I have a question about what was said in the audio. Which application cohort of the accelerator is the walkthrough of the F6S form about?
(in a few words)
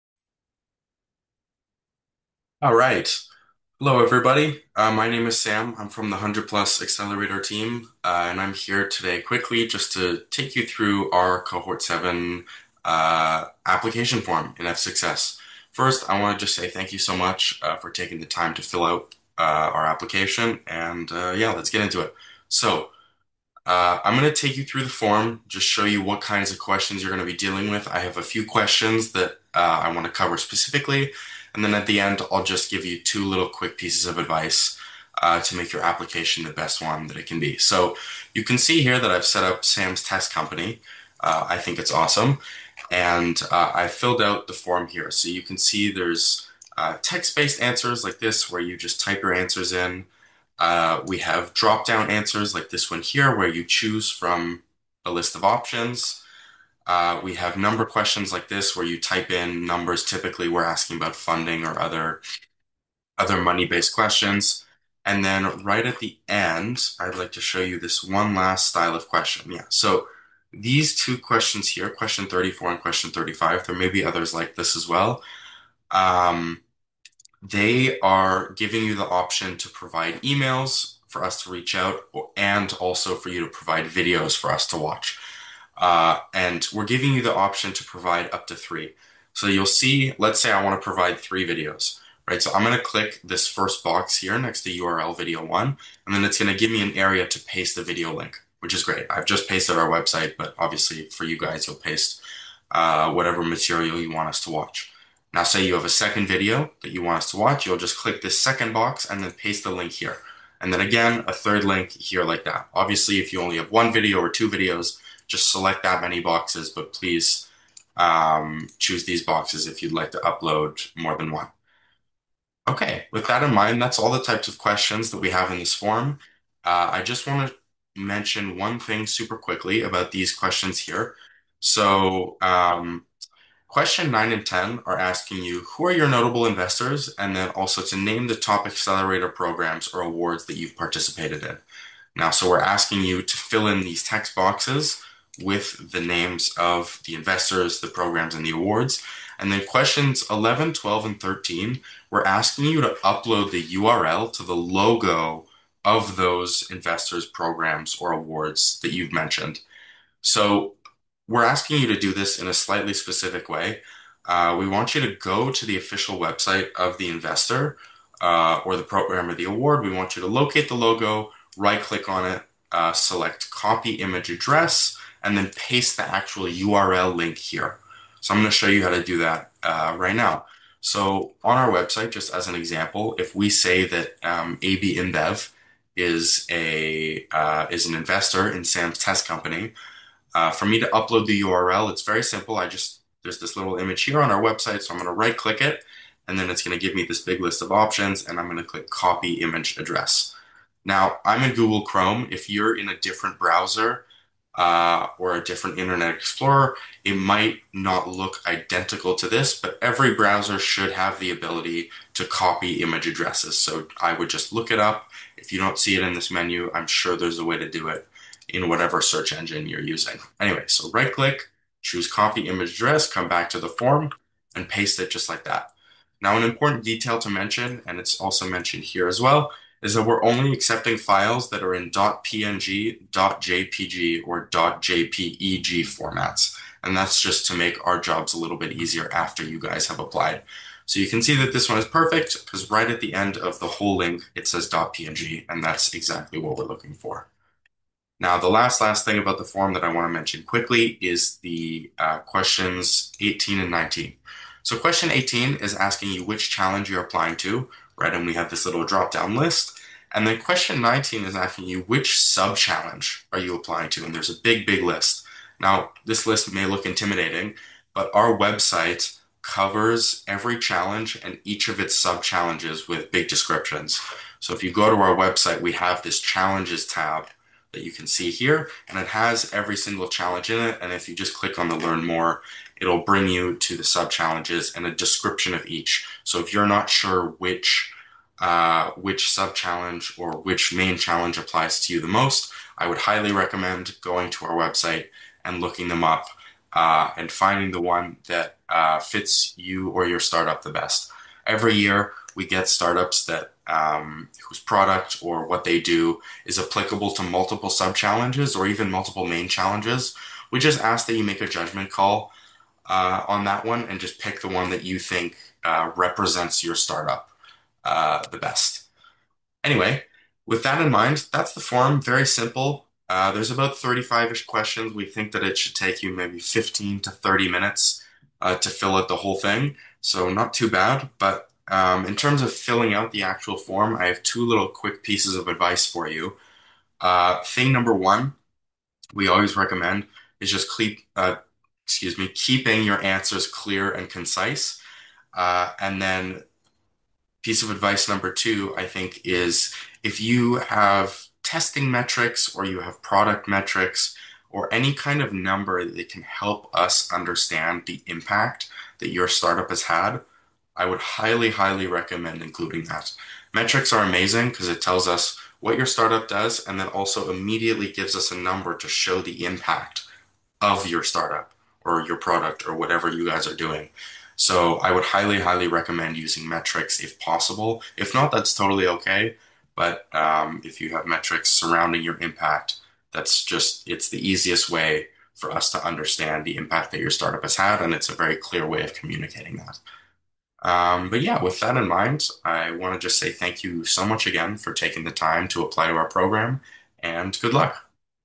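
Cohort 7.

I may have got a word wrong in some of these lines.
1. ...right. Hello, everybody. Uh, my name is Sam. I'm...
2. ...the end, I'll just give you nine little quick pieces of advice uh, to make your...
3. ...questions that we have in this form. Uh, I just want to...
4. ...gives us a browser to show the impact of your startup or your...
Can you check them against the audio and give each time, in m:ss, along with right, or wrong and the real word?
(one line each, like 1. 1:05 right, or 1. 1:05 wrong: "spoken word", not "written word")
1. 0:02 right
2. 0:31 wrong: "two", not "nine"
3. 2:04 right
4. 6:07 wrong: "number", not "browser".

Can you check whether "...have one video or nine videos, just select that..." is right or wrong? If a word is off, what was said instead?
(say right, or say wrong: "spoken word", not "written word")
wrong: "two", not "nine".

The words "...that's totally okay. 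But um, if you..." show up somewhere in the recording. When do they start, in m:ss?
6:18.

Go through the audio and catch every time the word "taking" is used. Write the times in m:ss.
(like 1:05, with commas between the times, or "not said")
0:17, 6:34.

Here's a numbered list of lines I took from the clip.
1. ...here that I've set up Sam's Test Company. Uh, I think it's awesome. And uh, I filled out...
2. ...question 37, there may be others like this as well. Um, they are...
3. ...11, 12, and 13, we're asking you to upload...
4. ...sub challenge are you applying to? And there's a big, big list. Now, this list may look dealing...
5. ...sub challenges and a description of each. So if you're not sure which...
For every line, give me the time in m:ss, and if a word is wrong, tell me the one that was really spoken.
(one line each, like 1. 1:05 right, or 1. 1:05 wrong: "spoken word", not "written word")
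1. 0:38 right
2. 1:12 wrong: "35", not "37"
3. 2:30 right
4. 4:22 wrong: "intimidating", not "dealing"
5. 4:43 right.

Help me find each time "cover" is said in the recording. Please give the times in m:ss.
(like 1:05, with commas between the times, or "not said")
0:30, 4:29.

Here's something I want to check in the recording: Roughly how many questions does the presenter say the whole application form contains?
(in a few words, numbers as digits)
35.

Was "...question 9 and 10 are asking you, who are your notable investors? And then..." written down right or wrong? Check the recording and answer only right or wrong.
right.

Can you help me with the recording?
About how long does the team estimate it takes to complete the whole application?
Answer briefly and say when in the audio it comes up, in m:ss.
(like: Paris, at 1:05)
15 to 30 minutes, at 5:26.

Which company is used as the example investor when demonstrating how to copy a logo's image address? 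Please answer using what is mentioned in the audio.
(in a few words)
AB InBev.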